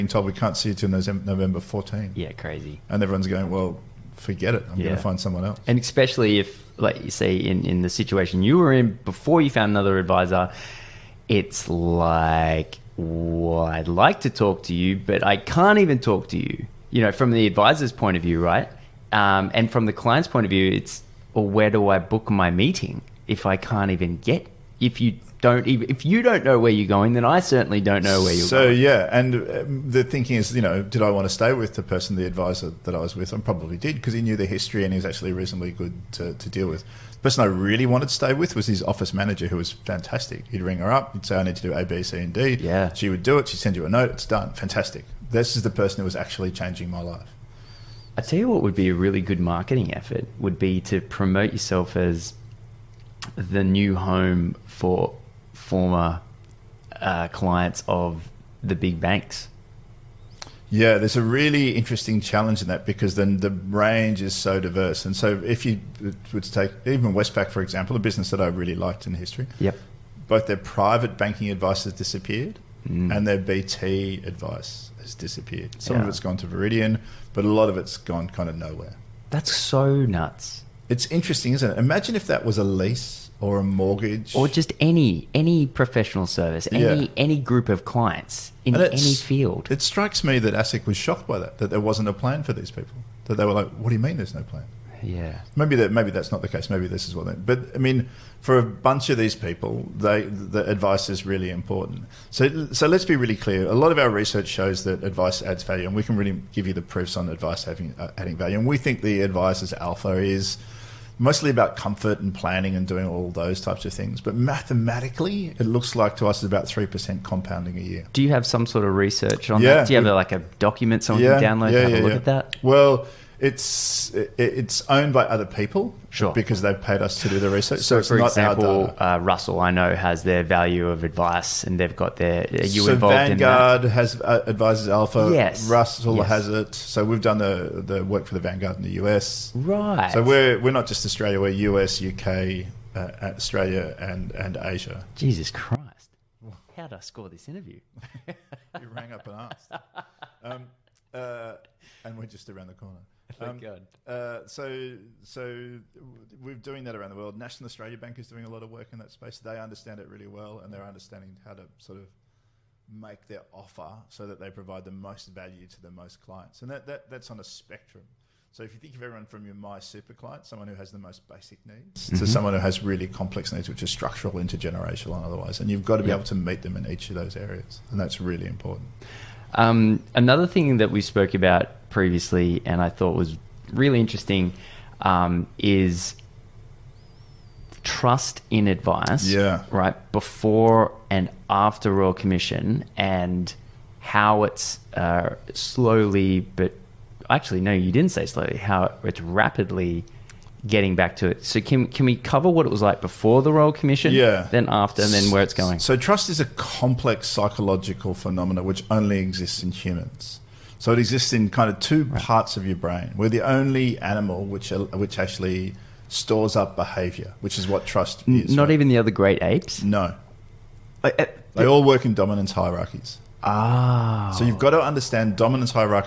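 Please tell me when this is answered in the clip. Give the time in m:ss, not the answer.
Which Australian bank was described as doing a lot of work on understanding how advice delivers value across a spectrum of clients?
2:37.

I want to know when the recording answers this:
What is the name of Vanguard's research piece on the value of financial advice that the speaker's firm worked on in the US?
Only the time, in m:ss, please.
2:14.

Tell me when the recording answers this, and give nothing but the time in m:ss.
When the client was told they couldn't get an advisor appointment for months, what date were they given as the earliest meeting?
0:00.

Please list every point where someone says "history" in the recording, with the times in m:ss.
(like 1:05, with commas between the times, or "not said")
0:34, 1:09.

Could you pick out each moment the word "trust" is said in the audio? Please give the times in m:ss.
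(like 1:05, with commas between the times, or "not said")
3:07, 3:25, 3:37.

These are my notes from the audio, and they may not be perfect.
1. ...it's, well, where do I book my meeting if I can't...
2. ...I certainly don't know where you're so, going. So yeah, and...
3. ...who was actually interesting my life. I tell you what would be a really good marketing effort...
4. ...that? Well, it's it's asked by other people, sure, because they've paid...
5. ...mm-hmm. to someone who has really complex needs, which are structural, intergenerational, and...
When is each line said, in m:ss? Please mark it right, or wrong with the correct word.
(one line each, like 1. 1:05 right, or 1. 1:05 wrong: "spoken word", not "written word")
1. 0:20 right
2. 0:27 right
3. 0:46 wrong: "changing", not "interesting"
4. 2:02 wrong: "owned", not "asked"
5. 2:52 right.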